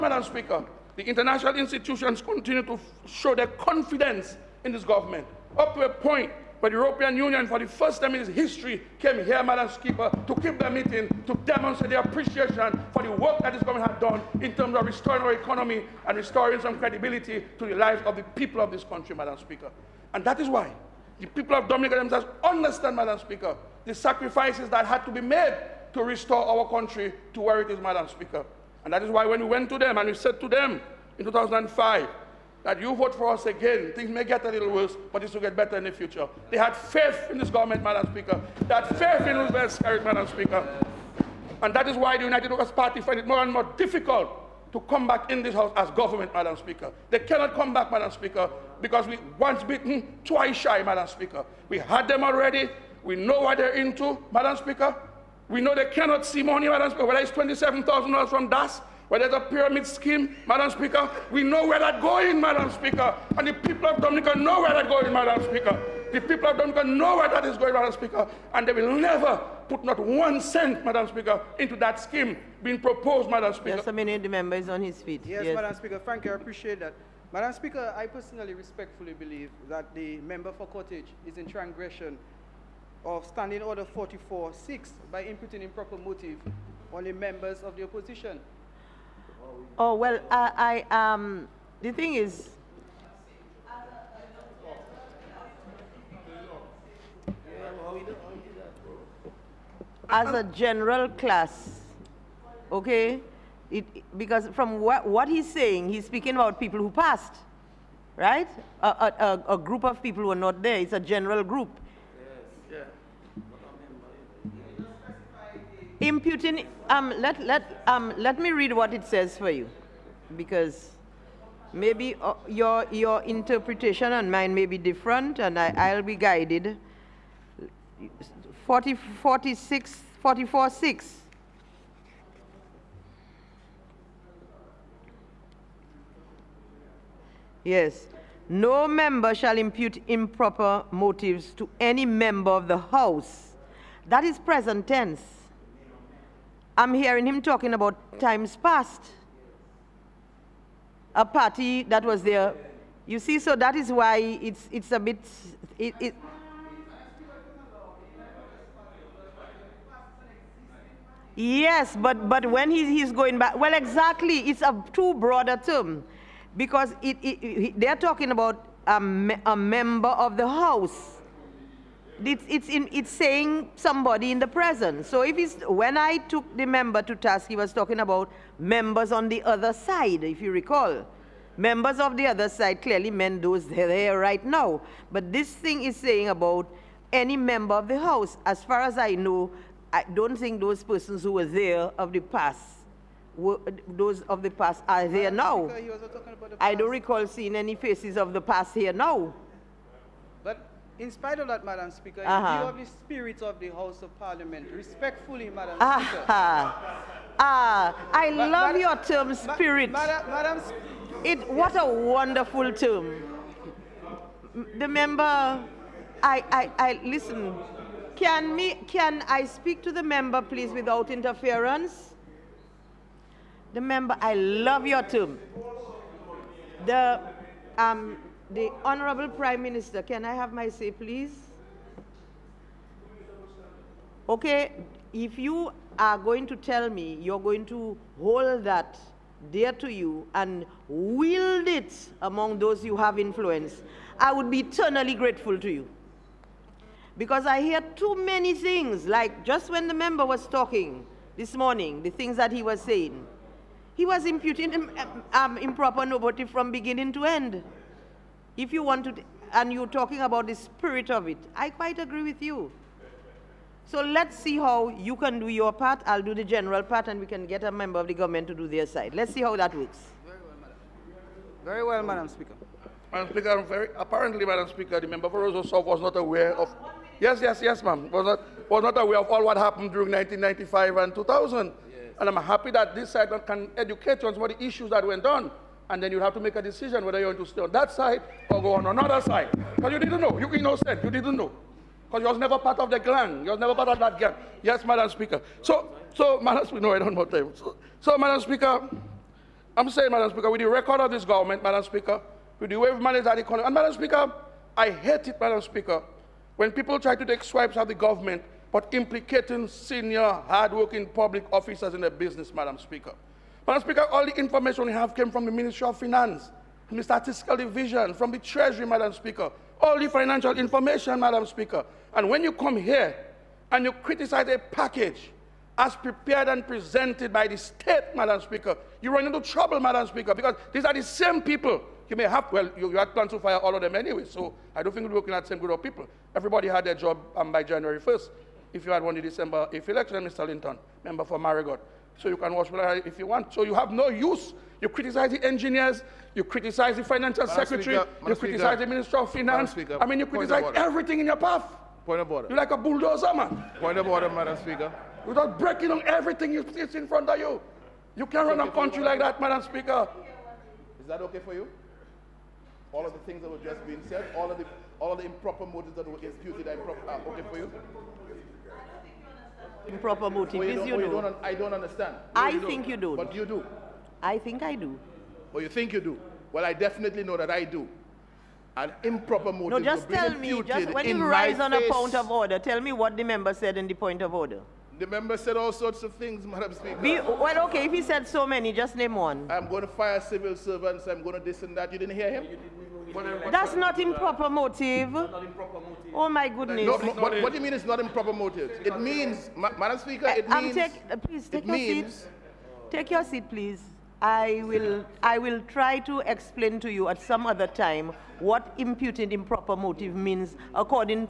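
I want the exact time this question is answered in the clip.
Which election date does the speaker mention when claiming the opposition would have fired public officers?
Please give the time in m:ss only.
5:39.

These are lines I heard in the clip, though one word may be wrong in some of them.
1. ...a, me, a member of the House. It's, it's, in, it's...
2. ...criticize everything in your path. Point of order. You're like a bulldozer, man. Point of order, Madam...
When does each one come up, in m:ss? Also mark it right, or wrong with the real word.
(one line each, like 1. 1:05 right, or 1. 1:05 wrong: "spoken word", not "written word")
1. 2:48 right
2. 5:50 right.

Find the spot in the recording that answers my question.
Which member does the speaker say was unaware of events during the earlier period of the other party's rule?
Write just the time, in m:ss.
4:34.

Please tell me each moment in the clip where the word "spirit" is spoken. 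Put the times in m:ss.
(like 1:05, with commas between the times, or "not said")
3:22, 3:29, 4:20.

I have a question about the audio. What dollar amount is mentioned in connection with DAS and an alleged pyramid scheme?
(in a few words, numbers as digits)
$27,000.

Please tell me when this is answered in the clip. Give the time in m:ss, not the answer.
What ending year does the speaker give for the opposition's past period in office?
4:41.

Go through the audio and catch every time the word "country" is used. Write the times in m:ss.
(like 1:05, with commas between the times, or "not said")
0:18, 0:26, 5:58.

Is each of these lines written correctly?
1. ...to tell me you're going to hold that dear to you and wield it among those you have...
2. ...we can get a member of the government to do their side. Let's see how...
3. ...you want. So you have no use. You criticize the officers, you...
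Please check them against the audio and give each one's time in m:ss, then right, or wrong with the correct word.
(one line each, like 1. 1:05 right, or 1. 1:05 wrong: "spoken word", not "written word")
1. 3:56 right
2. 4:27 right
3. 5:43 wrong: "engineers", not "officers".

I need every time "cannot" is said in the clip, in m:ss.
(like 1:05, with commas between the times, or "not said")
0:47, 0:55.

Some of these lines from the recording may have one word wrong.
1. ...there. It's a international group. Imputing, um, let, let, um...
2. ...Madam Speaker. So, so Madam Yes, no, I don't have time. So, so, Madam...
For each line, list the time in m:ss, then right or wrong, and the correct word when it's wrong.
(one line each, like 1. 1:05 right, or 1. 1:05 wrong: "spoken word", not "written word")
1. 1:50 wrong: "general", not "international"
2. 4:54 wrong: "Speaker", not "Yes".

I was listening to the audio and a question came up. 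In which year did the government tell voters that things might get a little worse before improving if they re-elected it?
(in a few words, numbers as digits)
2005.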